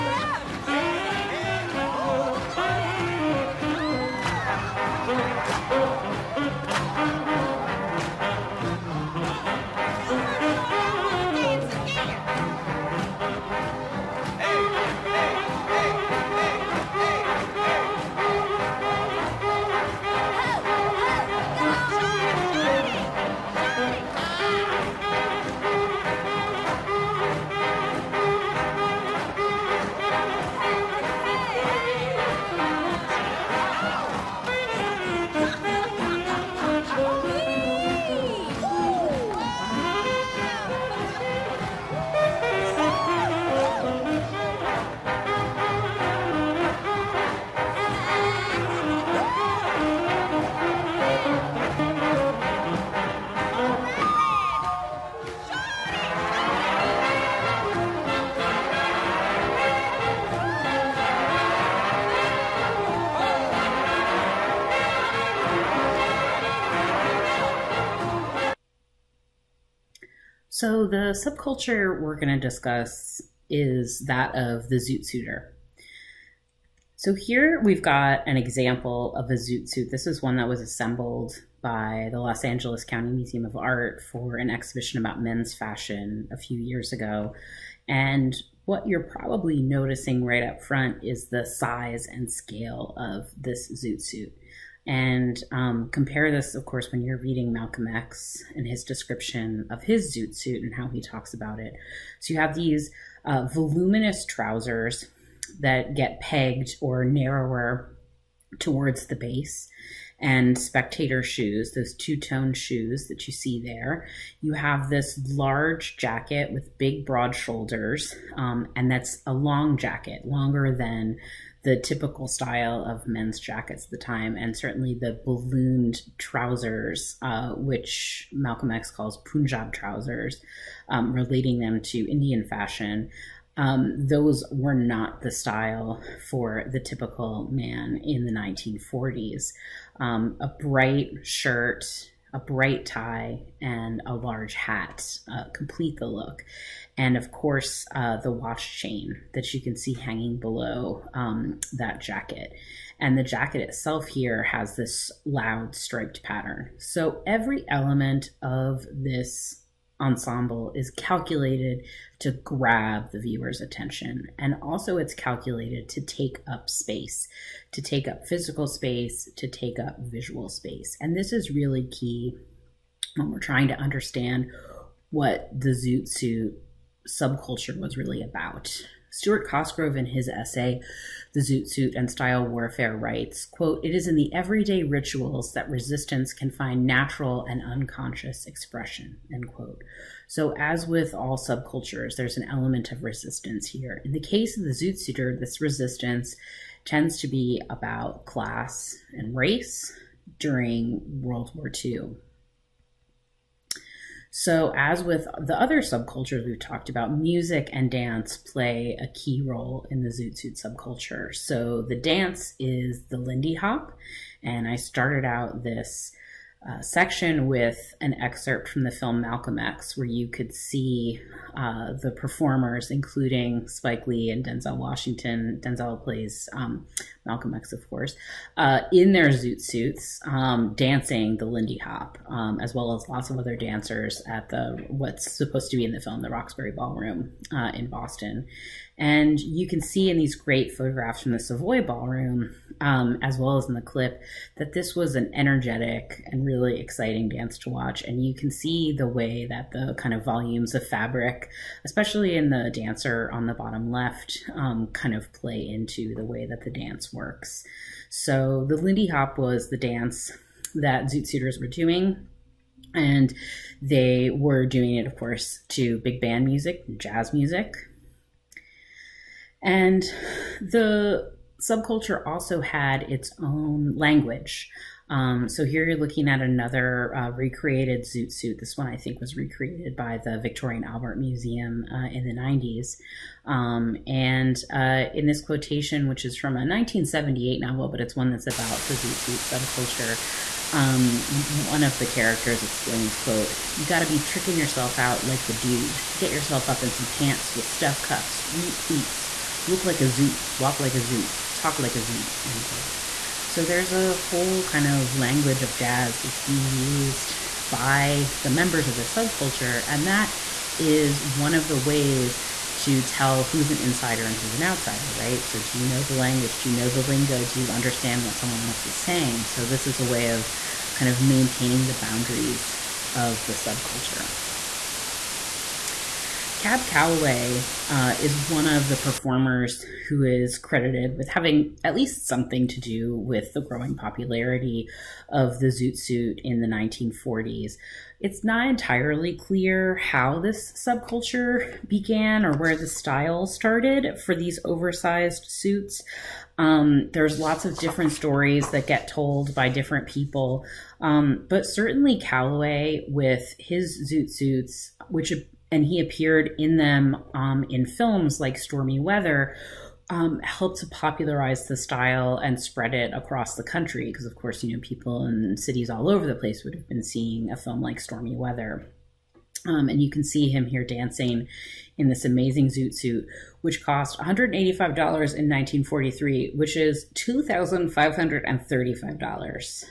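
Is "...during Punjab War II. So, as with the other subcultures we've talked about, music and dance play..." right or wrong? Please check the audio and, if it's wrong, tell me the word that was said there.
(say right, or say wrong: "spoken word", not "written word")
wrong: "World", not "Punjab".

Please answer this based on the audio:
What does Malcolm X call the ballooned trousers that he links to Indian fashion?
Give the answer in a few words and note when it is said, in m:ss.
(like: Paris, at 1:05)
Punjab trousers, at 2:09.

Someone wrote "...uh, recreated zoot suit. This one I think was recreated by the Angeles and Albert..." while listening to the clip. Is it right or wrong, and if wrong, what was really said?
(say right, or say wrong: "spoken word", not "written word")
wrong: "Victoria", not "Angeles".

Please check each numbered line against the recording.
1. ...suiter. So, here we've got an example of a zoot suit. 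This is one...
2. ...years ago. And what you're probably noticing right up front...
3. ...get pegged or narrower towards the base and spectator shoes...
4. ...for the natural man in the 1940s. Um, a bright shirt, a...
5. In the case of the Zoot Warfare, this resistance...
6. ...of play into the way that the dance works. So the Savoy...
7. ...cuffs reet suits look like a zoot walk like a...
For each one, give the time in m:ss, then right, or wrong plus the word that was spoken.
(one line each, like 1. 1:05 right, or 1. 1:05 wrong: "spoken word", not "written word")
1. 1:15 right
2. 1:26 right
3. 1:45 right
4. 2:16 wrong: "typical", not "natural"
5. 3:14 wrong: "Suiter", not "Warfare"
6. 4:15 wrong: "Lindy", not "Savoy"
7. 4:58 wrong: "pleats", not "suits".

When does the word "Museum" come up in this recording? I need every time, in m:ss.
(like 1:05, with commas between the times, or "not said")
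1:23, 4:41.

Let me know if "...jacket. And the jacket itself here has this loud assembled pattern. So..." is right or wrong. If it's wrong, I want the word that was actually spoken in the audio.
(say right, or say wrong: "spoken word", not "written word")
wrong: "striped", not "assembled".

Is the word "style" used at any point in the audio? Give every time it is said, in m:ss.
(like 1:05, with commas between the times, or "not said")
2:02, 2:15, 3:02, 5:42, 6:01.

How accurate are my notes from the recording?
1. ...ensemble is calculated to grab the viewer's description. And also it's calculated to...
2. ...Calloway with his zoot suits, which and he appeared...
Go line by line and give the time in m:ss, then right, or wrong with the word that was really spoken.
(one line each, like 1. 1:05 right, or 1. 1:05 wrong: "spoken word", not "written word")
1. 2:39 wrong: "attention", not "description"
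2. 5:52 right.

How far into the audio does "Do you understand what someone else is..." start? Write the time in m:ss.
5:17.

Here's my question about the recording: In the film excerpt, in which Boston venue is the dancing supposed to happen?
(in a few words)
Roxbury Ballroom.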